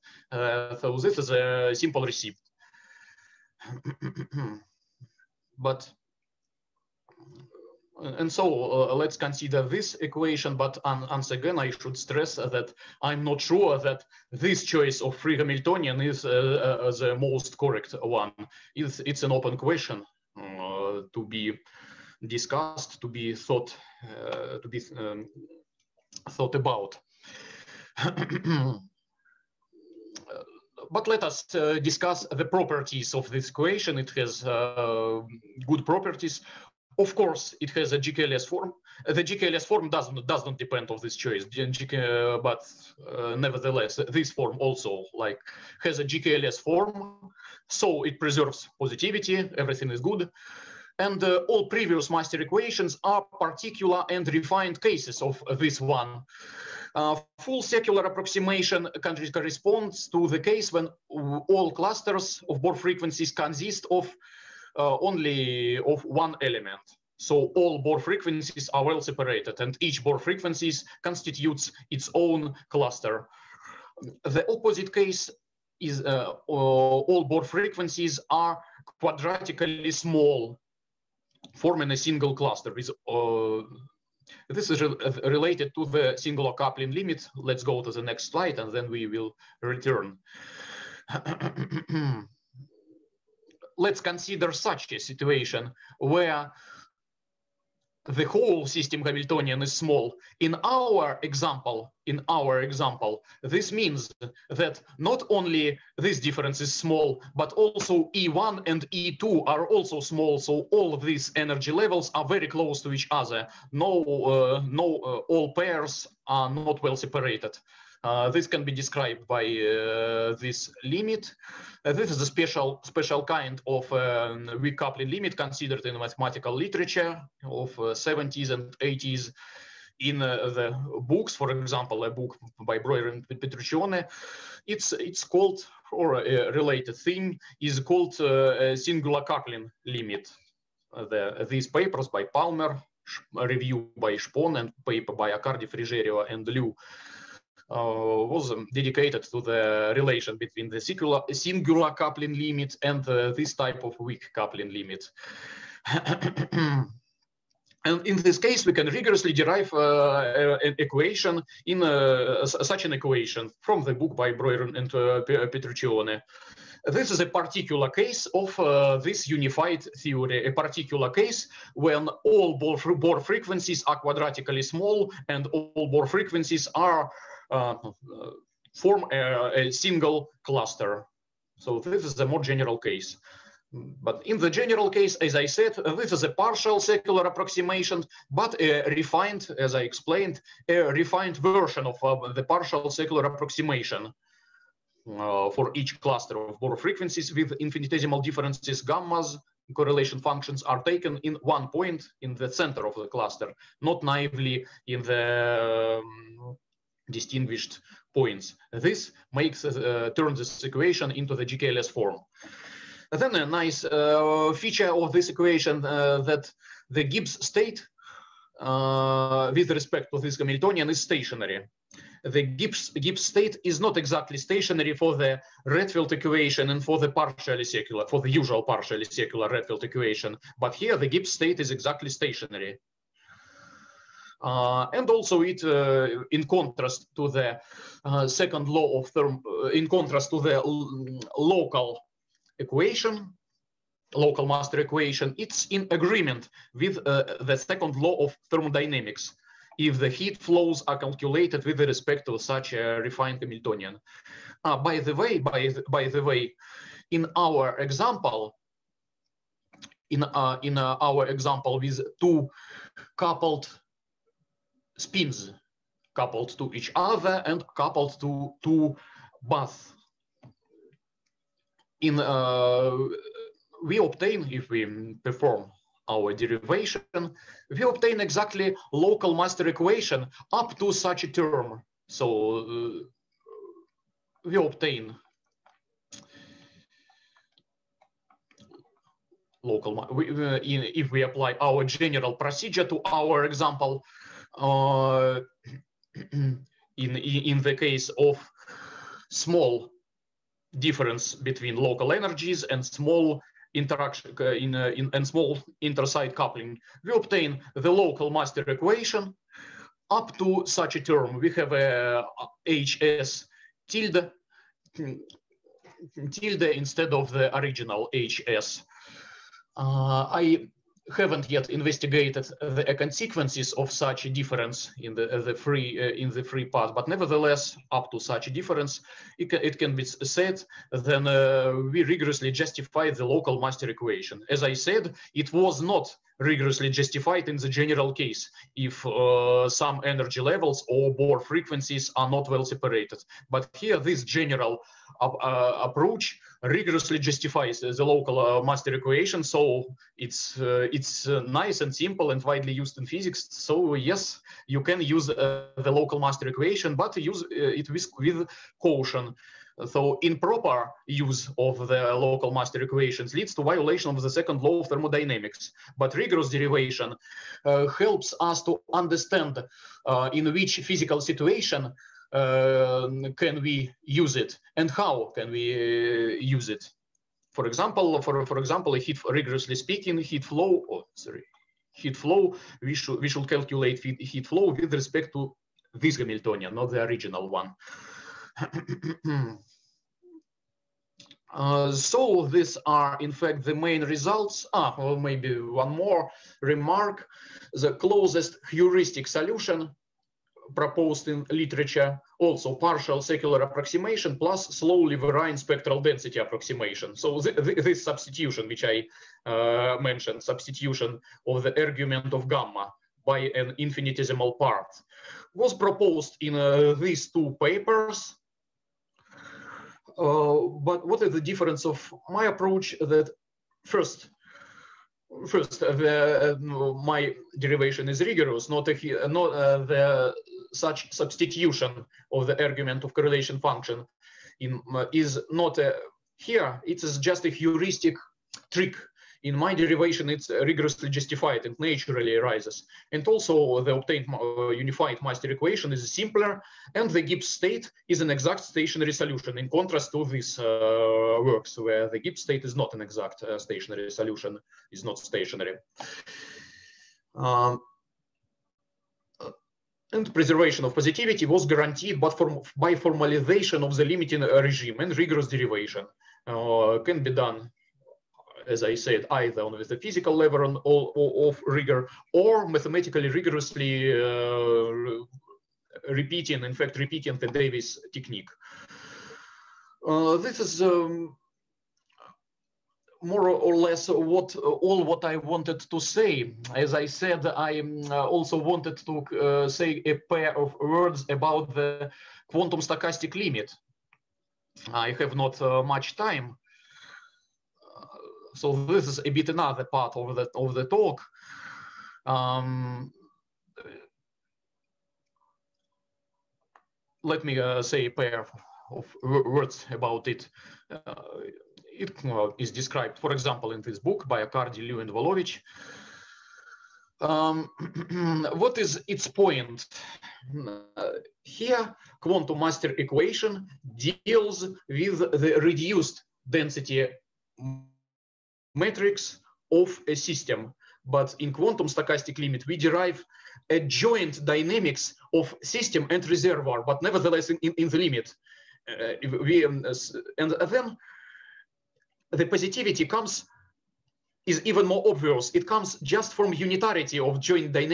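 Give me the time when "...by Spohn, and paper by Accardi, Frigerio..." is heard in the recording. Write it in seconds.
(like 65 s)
143 s.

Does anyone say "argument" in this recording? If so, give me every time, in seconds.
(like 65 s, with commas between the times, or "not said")
411 s, 432 s.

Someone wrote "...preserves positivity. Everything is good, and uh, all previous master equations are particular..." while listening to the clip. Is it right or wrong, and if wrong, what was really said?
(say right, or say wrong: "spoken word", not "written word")
right.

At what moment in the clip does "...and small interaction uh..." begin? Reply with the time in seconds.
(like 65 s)
302 s.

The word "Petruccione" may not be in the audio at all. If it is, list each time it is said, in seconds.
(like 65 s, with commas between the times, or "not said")
133 s, 165 s.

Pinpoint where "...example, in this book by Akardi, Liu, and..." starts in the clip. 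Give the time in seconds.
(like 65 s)
513 s.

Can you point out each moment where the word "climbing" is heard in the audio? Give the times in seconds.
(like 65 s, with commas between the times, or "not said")
not said.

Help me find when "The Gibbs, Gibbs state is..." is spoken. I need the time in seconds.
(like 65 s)
222 s.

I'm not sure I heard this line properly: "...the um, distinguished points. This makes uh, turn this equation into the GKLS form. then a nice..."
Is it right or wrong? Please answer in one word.
right.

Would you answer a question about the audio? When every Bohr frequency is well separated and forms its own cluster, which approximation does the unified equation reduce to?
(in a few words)
Full secular approximation.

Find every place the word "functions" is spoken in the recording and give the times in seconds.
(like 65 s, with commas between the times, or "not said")
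200 s, 433 s.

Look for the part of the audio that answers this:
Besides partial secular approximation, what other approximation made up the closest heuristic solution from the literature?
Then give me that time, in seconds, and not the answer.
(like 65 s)
404 s.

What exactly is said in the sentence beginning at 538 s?
Uh, we, um, and then the positivity comes is even more obvious.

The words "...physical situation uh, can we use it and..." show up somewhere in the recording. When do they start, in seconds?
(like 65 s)
370 s.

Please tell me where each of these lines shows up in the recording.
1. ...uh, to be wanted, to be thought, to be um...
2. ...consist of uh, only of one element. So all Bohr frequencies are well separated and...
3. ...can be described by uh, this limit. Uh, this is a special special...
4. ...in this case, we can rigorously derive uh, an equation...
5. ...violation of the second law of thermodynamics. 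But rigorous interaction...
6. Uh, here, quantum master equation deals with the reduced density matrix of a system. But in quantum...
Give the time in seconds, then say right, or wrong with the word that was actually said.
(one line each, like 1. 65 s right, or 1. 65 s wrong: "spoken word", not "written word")
1. 20 s wrong: "discussed", not "wanted"
2. 63 s right
3. 118 s right
4. 158 s right
5. 363 s wrong: "derivation", not "interaction"
6. 520 s right.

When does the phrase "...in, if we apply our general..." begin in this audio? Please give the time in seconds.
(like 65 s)
290 s.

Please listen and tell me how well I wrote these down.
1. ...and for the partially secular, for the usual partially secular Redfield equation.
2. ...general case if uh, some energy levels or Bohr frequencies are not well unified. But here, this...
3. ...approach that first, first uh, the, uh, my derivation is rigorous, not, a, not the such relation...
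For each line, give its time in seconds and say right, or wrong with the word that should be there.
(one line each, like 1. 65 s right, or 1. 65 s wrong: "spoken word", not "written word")
1. 226 s right
2. 337 s wrong: "separated", not "unified"
3. 422 s wrong: "substitution", not "relation".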